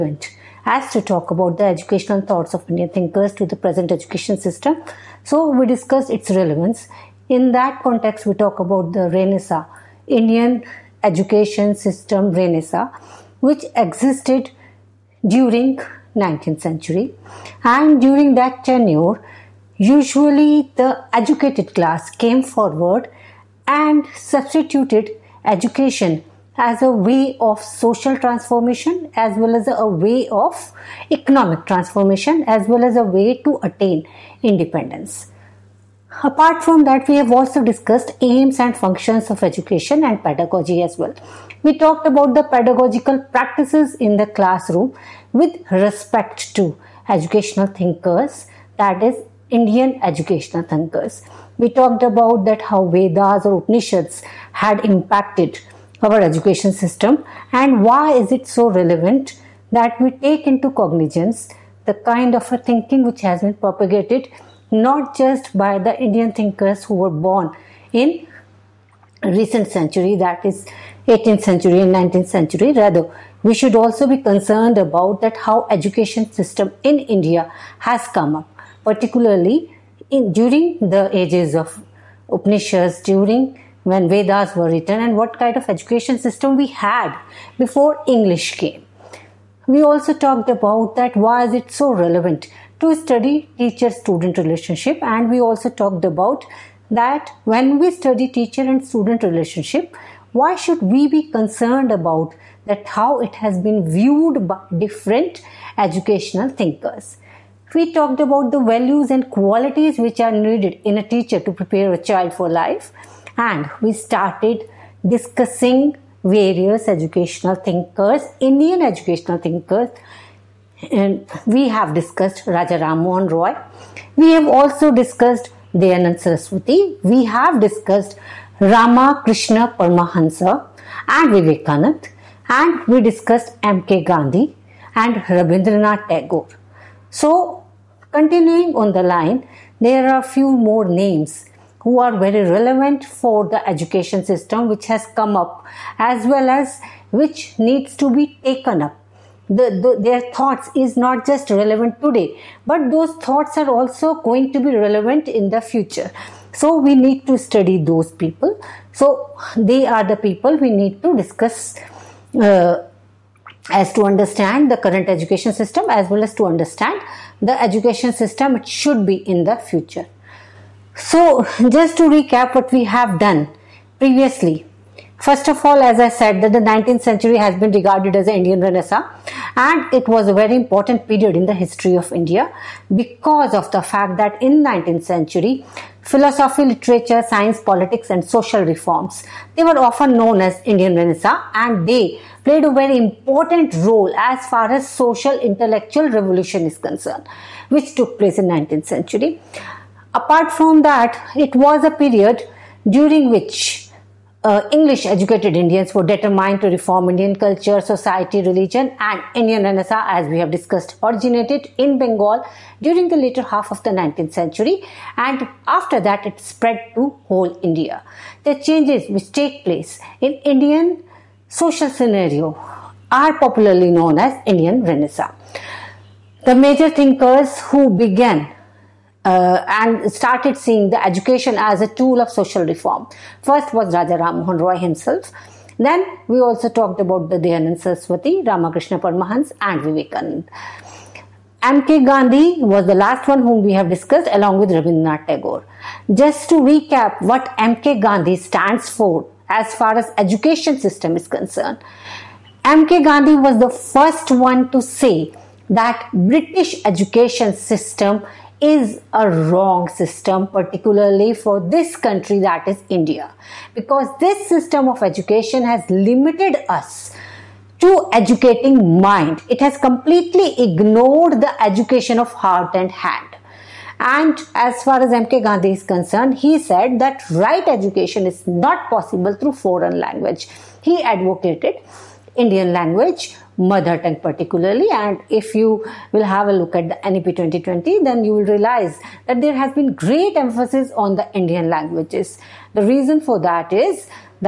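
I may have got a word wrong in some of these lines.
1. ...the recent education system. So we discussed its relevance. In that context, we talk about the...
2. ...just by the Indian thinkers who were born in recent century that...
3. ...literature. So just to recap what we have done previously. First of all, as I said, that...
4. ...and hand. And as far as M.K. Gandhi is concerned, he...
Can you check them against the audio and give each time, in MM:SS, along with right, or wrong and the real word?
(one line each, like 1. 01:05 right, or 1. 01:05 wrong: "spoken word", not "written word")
1. 00:03 wrong: "present", not "recent"
2. 01:05 right
3. 02:49 wrong: "future", not "literature"
4. 04:32 right.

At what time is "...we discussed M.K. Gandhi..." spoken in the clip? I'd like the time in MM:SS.
02:12.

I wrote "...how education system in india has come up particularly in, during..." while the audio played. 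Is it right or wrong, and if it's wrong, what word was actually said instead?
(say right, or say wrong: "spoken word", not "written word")
right.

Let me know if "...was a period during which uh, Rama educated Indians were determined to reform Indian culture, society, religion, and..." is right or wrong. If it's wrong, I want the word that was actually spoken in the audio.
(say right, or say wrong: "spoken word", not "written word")
wrong: "English", not "Rama".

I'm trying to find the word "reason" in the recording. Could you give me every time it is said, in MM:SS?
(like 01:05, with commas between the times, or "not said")
04:52.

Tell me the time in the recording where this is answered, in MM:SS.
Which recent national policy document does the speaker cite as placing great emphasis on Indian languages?
04:47.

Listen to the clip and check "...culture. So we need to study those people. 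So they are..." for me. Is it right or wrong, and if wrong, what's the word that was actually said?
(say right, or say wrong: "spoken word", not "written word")
wrong: "future", not "culture".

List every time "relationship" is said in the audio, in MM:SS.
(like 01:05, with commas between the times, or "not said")
01:34, 01:39.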